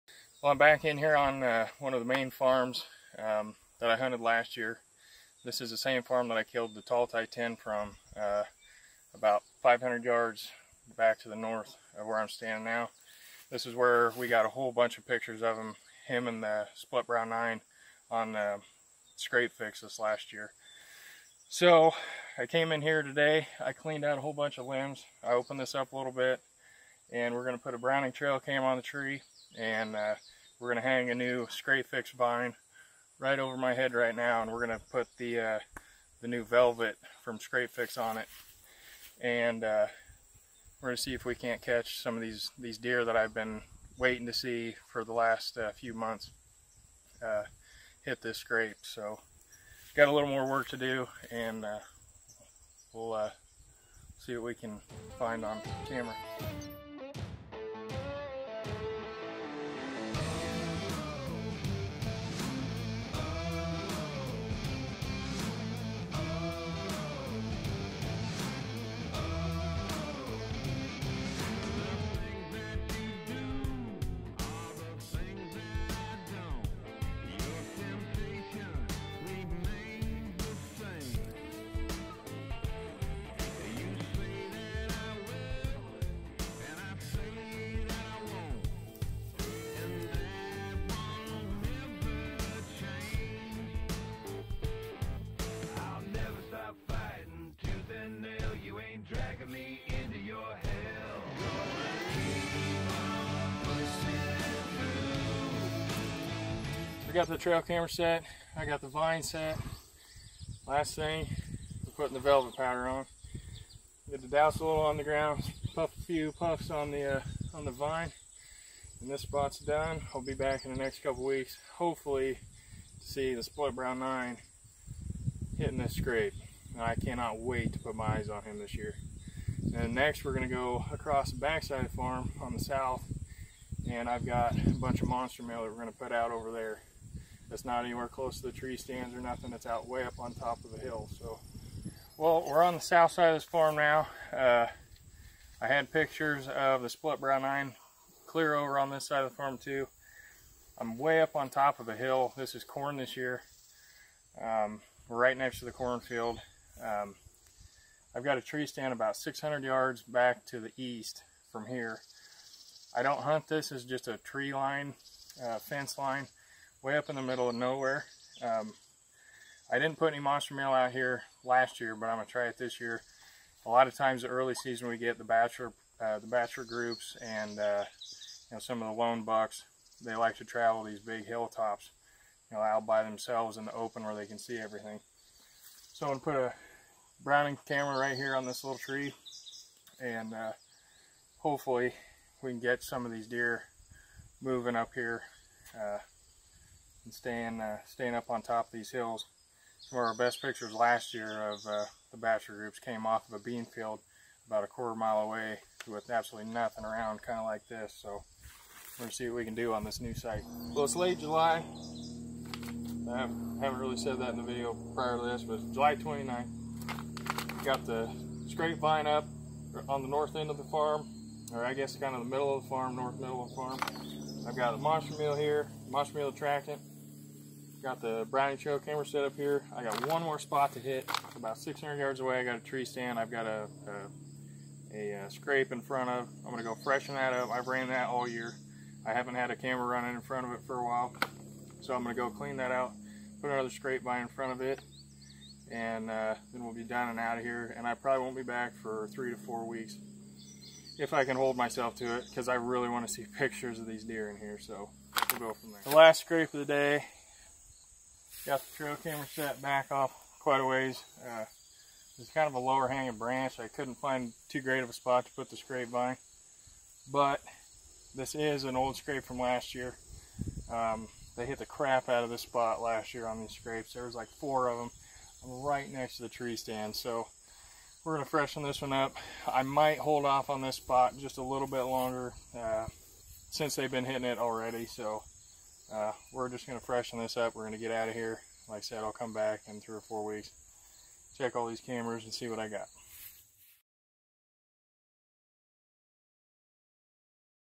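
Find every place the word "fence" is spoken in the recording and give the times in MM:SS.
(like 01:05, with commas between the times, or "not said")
02:45.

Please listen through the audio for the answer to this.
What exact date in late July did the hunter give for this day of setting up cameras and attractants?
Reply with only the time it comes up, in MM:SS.
03:35.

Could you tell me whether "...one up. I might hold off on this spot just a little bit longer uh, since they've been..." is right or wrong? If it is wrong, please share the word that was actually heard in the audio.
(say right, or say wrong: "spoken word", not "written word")
right.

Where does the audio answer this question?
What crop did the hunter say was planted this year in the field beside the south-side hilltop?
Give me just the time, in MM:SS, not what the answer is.
02:32.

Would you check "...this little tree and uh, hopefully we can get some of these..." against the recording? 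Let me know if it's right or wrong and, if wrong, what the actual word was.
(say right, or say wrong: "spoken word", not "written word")
right.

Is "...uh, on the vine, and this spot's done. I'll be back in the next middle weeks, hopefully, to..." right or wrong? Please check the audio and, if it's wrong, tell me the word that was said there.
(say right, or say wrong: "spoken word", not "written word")
wrong: "couple", not "middle".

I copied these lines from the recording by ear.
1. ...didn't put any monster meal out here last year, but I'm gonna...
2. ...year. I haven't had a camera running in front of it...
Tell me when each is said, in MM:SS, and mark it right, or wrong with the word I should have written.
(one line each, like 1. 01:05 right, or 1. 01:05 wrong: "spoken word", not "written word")
1. 02:49 right
2. 03:58 right.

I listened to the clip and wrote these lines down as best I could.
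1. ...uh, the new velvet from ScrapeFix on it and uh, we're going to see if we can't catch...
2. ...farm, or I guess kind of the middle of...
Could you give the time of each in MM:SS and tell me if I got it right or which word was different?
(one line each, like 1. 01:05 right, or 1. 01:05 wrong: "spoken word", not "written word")
1. 00:35 right
2. 03:40 right.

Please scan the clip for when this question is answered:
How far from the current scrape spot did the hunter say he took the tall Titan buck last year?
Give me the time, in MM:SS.
00:09.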